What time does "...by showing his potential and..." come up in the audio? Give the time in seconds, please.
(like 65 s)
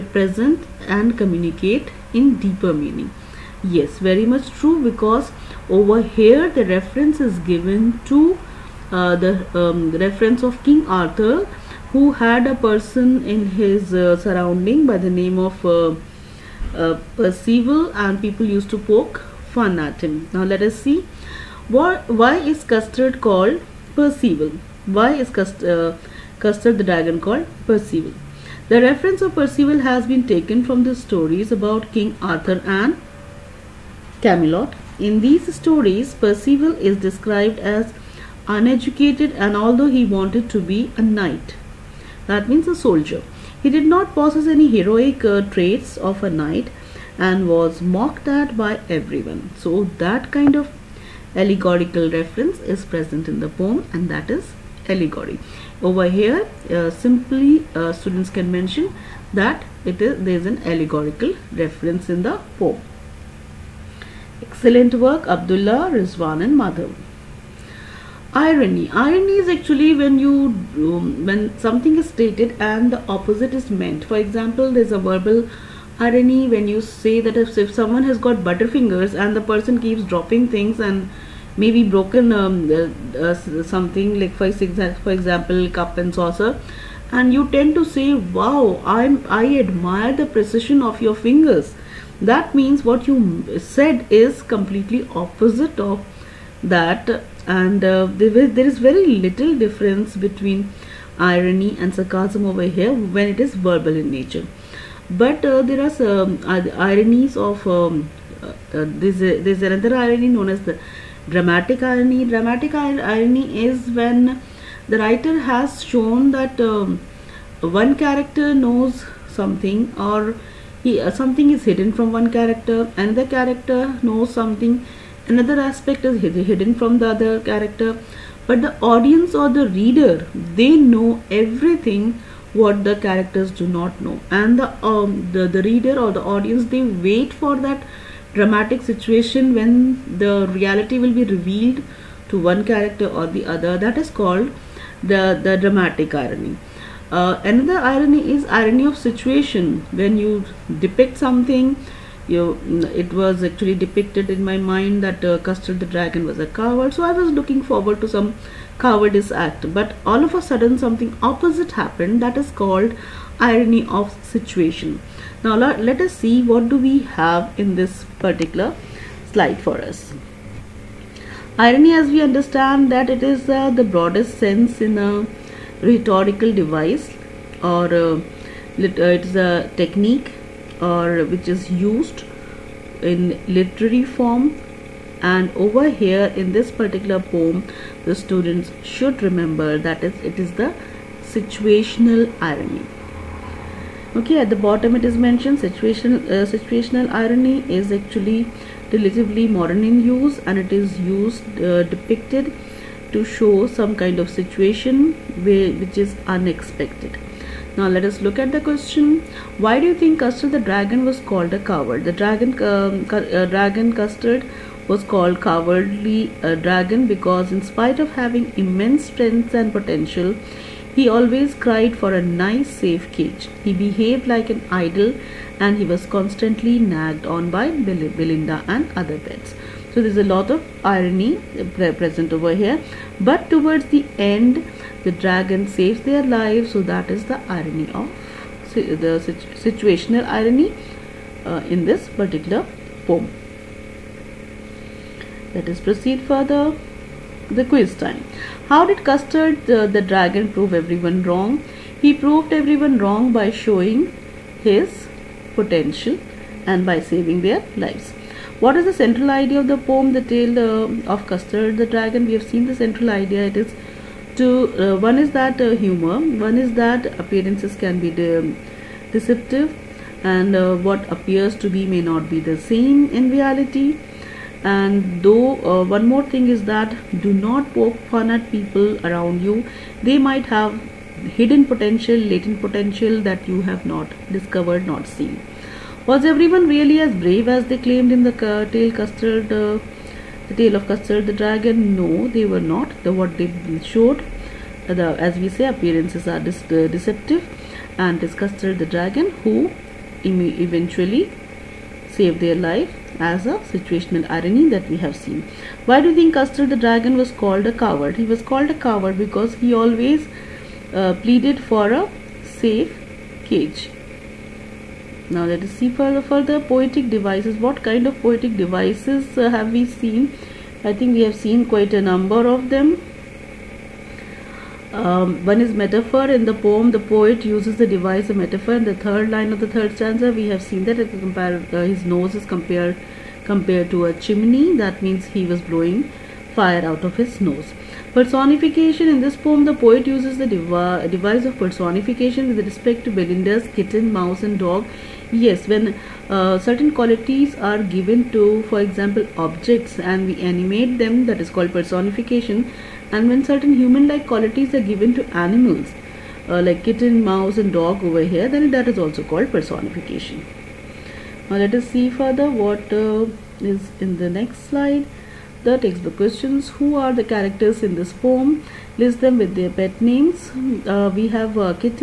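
253 s.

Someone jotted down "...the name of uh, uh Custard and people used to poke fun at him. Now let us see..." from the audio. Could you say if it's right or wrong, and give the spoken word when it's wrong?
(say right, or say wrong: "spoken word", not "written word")
wrong: "Percival", not "Custard".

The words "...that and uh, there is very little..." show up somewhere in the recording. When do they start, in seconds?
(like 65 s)
96 s.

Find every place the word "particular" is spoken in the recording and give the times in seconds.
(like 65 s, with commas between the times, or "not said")
168 s, 186 s, 242 s.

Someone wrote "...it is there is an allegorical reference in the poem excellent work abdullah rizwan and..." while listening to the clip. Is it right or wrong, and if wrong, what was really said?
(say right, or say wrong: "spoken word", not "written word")
right.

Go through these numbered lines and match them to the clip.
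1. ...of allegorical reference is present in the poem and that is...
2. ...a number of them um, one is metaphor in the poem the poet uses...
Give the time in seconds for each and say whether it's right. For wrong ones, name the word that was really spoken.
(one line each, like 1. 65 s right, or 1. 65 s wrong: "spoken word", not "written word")
1. 50 s right
2. 321 s right.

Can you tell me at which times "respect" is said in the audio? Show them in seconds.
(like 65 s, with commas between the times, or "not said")
342 s.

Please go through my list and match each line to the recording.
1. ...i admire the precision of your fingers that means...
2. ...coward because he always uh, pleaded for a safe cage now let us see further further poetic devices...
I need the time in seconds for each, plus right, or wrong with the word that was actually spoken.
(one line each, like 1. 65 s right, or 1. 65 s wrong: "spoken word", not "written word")
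1. 89 s right
2. 308 s right.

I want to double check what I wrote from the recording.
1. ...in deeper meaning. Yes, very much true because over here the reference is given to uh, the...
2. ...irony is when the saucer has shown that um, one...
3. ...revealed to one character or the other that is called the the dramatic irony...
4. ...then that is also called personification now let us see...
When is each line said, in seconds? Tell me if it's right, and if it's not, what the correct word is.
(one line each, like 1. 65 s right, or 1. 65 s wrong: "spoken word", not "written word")
1. 2 s right
2. 112 s wrong: "writer", not "saucer"
3. 141 s right
4. 358 s right.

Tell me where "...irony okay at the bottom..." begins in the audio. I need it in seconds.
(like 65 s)
192 s.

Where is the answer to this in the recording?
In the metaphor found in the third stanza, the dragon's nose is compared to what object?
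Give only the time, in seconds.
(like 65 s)
334 s.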